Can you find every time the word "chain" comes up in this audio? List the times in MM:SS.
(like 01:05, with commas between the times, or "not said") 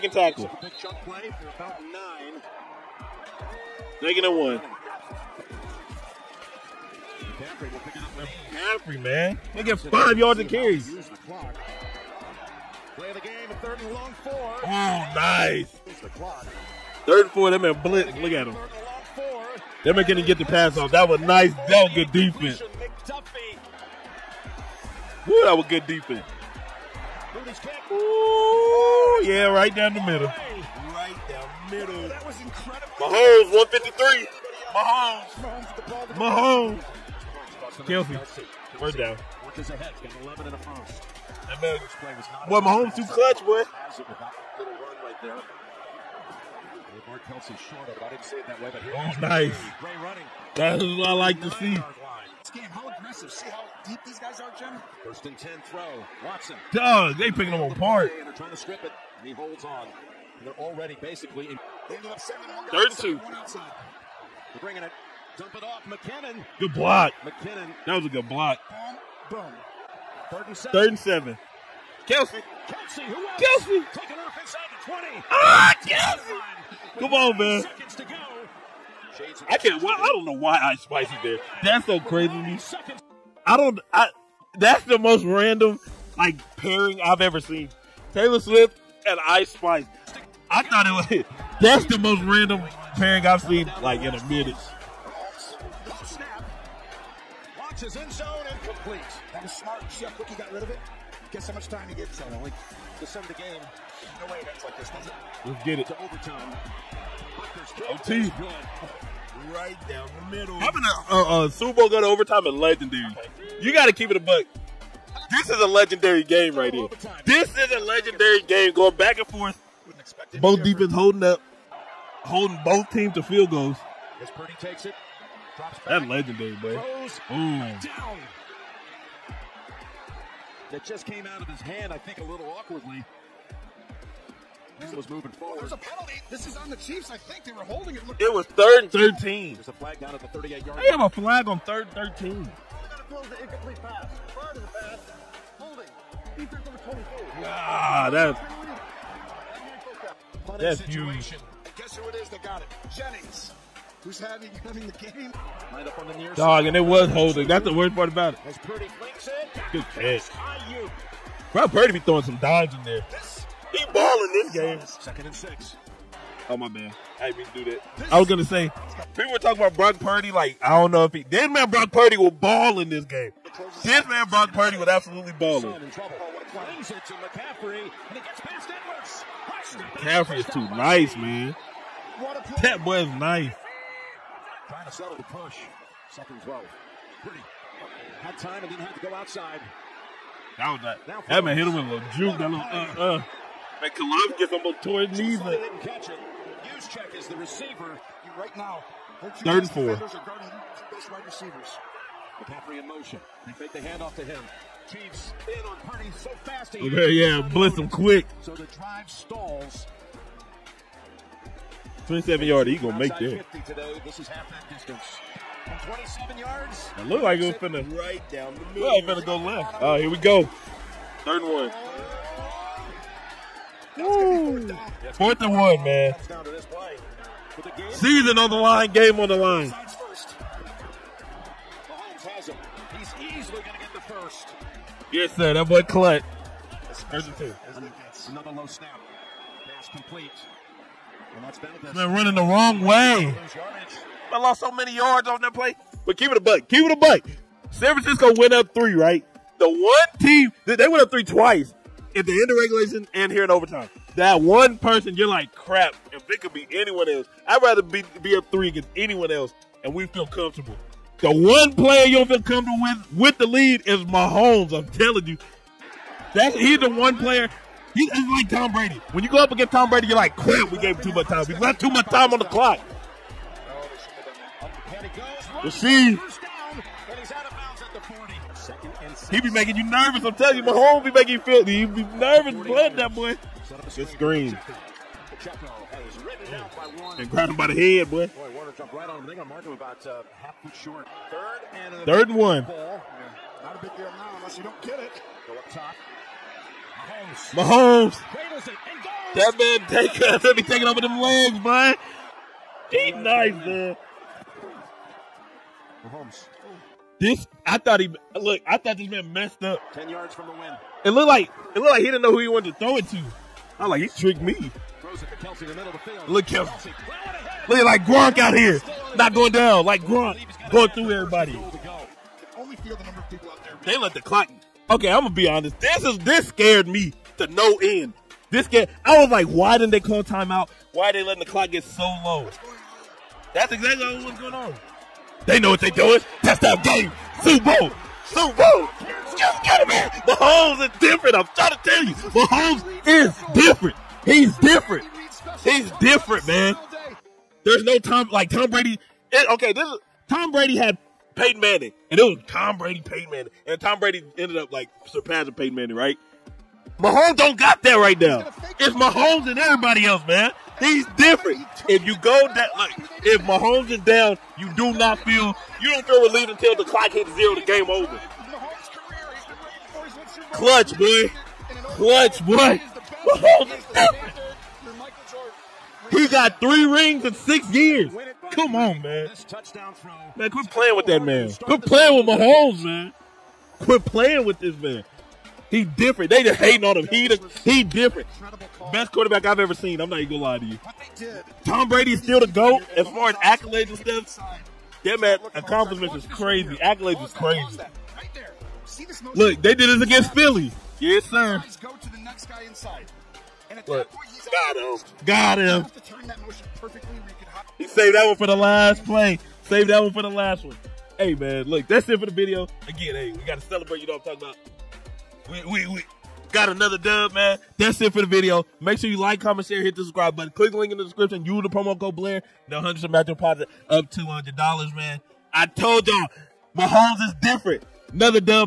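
not said.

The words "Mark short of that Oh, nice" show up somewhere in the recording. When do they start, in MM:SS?
00:47.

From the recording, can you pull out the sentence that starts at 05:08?
I thought this man messed up.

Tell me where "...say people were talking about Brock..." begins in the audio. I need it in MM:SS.
02:48.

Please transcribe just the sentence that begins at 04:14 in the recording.
That one person, you're like, crap.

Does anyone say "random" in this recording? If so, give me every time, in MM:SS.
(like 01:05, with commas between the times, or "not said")
01:25, 01:32.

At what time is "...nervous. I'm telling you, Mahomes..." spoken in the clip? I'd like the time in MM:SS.
04:39.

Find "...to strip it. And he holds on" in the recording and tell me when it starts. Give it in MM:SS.
00:58.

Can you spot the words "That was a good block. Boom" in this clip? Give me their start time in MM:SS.
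01:07.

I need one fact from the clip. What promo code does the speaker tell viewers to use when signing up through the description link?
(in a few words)
Blair.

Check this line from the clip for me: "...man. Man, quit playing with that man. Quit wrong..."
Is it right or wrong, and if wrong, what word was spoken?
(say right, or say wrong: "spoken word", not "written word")
wrong: "playing", not "wrong".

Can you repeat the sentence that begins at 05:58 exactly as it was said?
It's Mahomes and everybody else, man.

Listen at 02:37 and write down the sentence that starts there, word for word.
That's the worst part about it.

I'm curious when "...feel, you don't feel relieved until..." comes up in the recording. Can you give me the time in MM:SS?
06:05.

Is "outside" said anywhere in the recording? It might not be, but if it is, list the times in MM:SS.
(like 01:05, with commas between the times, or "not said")
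03:09.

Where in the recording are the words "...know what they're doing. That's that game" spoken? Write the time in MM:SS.
05:35.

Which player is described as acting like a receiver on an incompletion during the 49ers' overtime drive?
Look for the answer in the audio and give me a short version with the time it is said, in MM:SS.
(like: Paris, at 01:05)
Juszczyk, at 03:16.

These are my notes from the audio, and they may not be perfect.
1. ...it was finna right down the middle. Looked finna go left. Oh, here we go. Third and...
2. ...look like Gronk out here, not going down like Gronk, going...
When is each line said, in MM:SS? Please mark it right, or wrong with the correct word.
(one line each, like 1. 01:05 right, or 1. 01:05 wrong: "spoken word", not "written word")
1. 03:37 right
2. 05:17 right.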